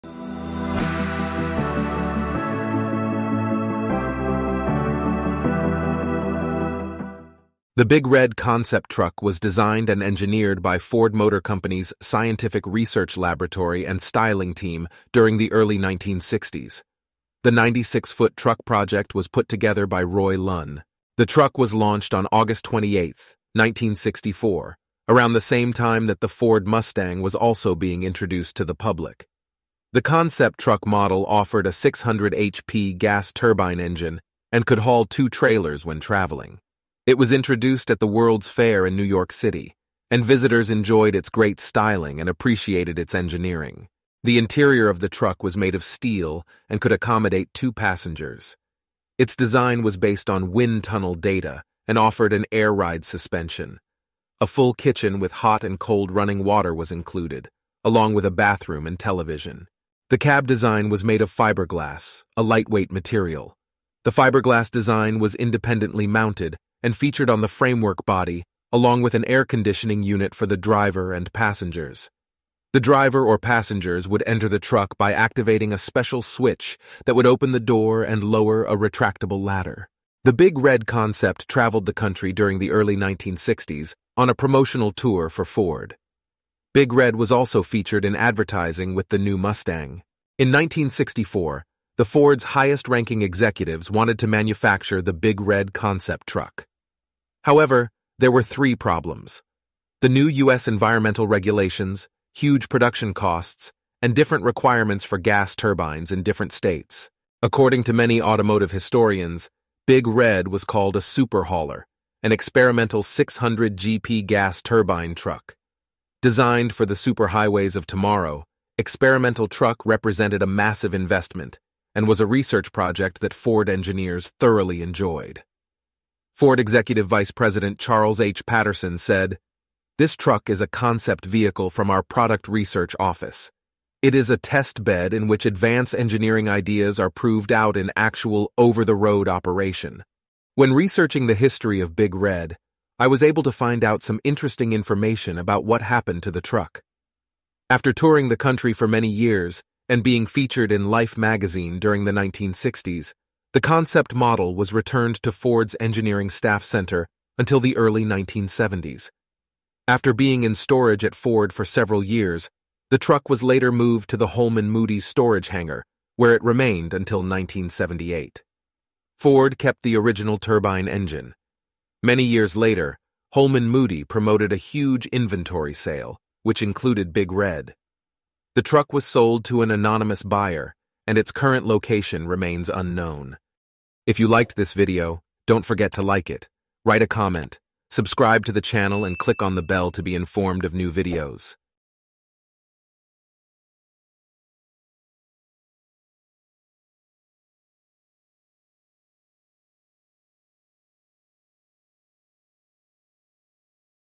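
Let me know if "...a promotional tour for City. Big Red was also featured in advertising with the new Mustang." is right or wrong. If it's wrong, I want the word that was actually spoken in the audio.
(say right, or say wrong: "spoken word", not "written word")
wrong: "Ford", not "City".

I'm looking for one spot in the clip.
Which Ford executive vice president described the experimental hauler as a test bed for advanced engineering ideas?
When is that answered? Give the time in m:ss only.
2:07.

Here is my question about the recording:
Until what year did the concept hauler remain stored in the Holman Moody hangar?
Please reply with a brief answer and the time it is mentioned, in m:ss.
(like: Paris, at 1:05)
1978, at 2:47.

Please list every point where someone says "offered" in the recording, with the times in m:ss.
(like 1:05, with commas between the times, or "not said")
0:31, 0:51.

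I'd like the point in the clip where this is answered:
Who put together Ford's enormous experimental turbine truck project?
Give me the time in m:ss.
0:20.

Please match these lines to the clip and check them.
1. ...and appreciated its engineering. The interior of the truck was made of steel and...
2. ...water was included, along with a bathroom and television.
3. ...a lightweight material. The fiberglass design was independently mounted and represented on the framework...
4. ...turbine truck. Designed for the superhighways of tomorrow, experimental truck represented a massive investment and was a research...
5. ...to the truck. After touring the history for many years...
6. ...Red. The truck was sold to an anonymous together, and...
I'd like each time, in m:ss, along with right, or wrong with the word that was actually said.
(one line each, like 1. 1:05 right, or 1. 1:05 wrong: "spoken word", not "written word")
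1. 0:42 right
2. 0:56 right
3. 1:02 wrong: "featured", not "represented"
4. 1:54 right
5. 2:26 wrong: "country", not "history"
6. 2:57 wrong: "buyer", not "together".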